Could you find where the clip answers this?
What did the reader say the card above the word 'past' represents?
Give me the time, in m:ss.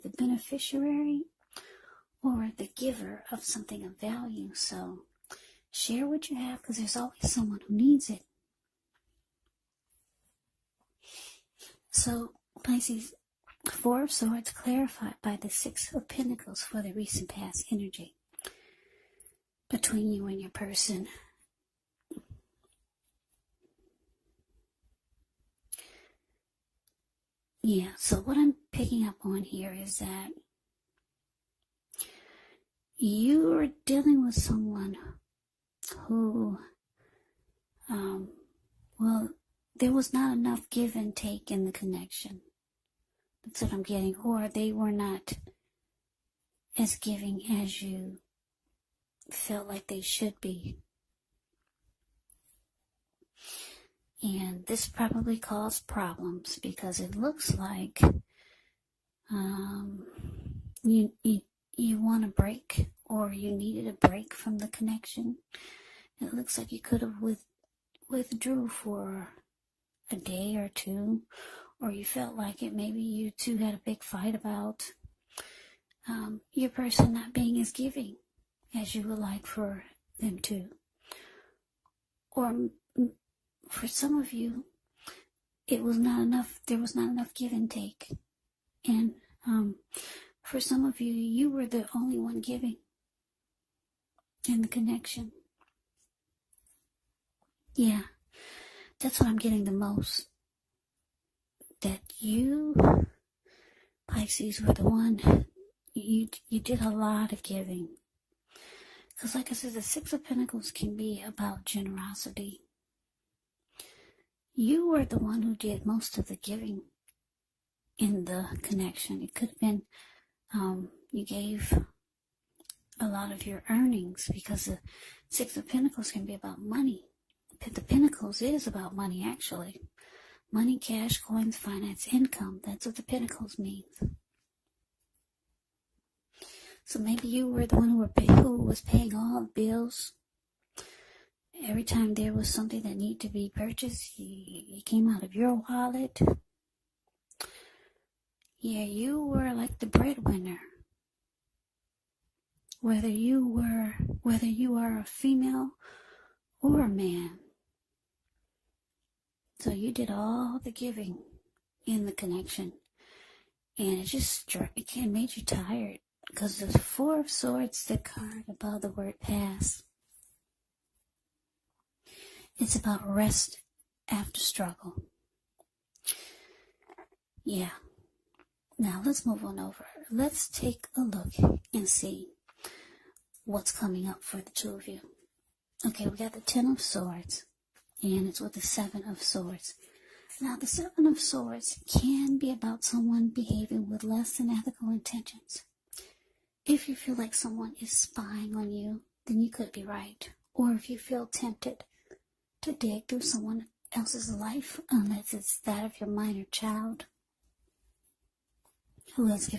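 2:53.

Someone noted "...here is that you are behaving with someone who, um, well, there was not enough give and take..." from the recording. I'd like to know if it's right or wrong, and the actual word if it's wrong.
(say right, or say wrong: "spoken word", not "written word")
wrong: "dealing", not "behaving".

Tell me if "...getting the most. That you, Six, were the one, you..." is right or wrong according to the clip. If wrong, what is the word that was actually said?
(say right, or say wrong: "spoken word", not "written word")
wrong: "Pisces", not "Six".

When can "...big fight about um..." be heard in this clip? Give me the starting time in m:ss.
1:13.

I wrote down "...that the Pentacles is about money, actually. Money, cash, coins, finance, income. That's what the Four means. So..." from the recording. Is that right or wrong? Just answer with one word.
wrong.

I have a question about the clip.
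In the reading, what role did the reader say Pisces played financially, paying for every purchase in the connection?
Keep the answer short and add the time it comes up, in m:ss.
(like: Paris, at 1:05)
the breadwinner, at 2:29.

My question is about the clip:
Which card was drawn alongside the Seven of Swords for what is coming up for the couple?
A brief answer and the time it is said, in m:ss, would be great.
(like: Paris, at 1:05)
Ten of Swords, at 3:06.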